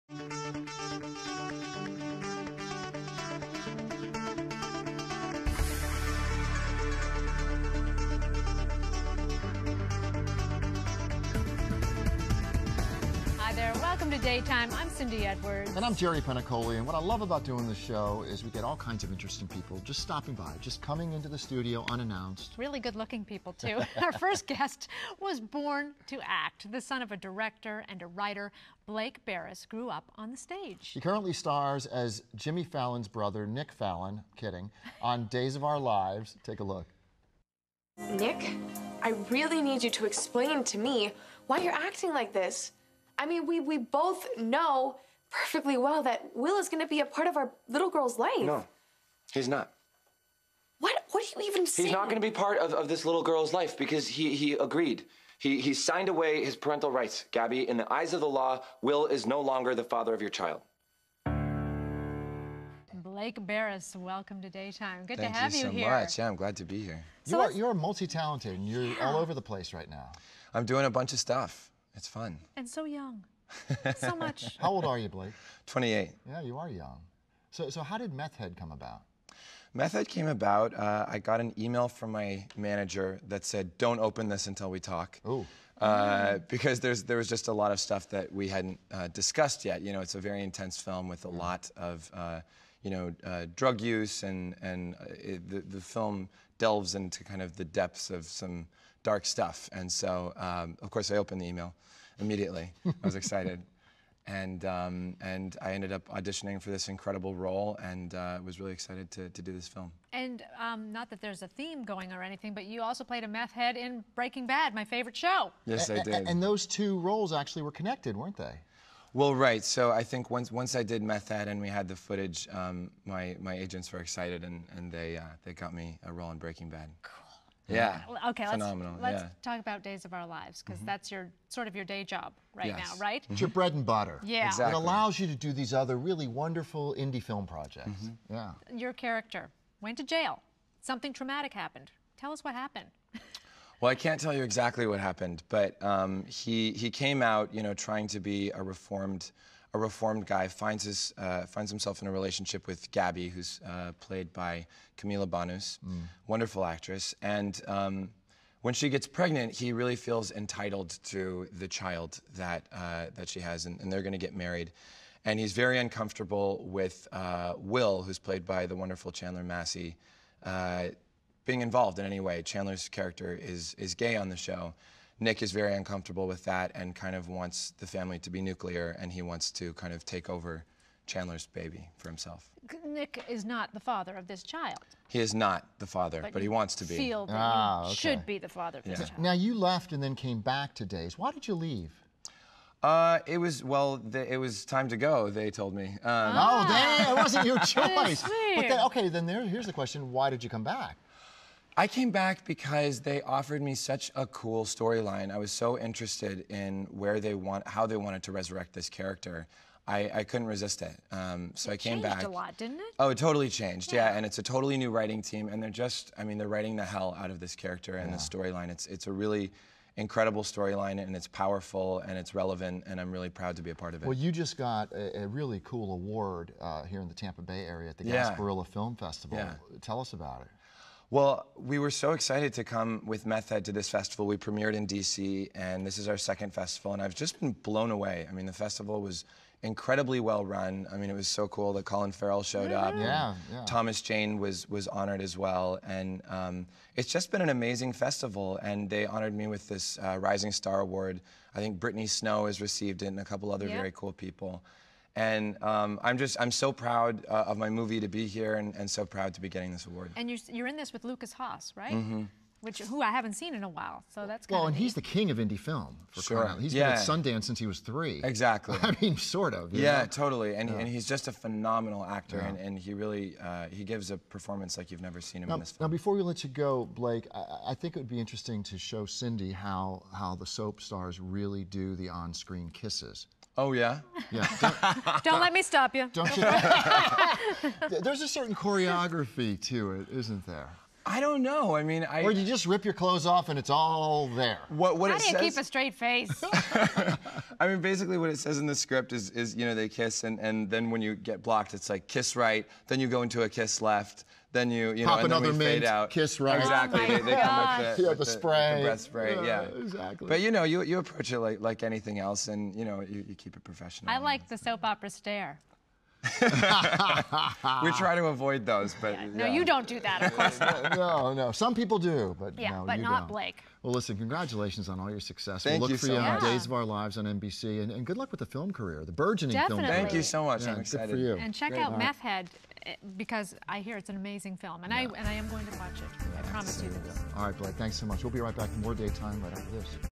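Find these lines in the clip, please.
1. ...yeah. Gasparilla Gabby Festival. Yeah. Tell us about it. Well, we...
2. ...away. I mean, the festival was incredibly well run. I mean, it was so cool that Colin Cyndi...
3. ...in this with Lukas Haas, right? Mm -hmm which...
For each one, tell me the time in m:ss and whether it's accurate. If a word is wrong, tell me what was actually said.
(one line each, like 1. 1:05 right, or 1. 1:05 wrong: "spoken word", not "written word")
1. 3:48 wrong: "Film", not "Gabby"
2. 3:57 wrong: "Farrell", not "Cyndi"
3. 4:20 right.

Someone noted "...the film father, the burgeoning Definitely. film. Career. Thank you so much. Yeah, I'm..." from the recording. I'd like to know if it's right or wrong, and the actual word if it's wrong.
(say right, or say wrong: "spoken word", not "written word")
wrong: "career", not "father".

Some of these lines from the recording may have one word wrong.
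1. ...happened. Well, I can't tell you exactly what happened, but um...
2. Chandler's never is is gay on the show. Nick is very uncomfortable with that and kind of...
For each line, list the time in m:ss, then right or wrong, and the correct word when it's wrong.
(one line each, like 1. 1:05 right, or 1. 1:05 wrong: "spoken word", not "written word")
1. 2:22 right
2. 2:52 wrong: "character", not "never".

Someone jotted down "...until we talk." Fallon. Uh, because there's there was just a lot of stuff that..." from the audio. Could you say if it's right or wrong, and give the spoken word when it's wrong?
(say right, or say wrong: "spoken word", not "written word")
wrong: "Ooh", not "Fallon".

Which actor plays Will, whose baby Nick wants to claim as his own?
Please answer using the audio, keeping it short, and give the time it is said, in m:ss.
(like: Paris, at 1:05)
Chandler Massey, at 2:49.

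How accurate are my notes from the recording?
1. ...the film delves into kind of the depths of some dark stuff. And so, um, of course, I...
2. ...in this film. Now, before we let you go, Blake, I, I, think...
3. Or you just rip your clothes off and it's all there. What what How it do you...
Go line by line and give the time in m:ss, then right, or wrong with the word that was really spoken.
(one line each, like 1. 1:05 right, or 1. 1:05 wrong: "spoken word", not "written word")
1. 1:35 right
2. 4:35 right
3. 4:52 right.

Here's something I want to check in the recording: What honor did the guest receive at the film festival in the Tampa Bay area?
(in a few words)
Rising Star Award.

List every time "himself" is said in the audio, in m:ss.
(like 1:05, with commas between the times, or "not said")
2:31, 3:02.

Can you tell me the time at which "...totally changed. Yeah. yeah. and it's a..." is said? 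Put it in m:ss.
3:33.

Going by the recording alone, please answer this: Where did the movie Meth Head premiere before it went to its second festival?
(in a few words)
DC.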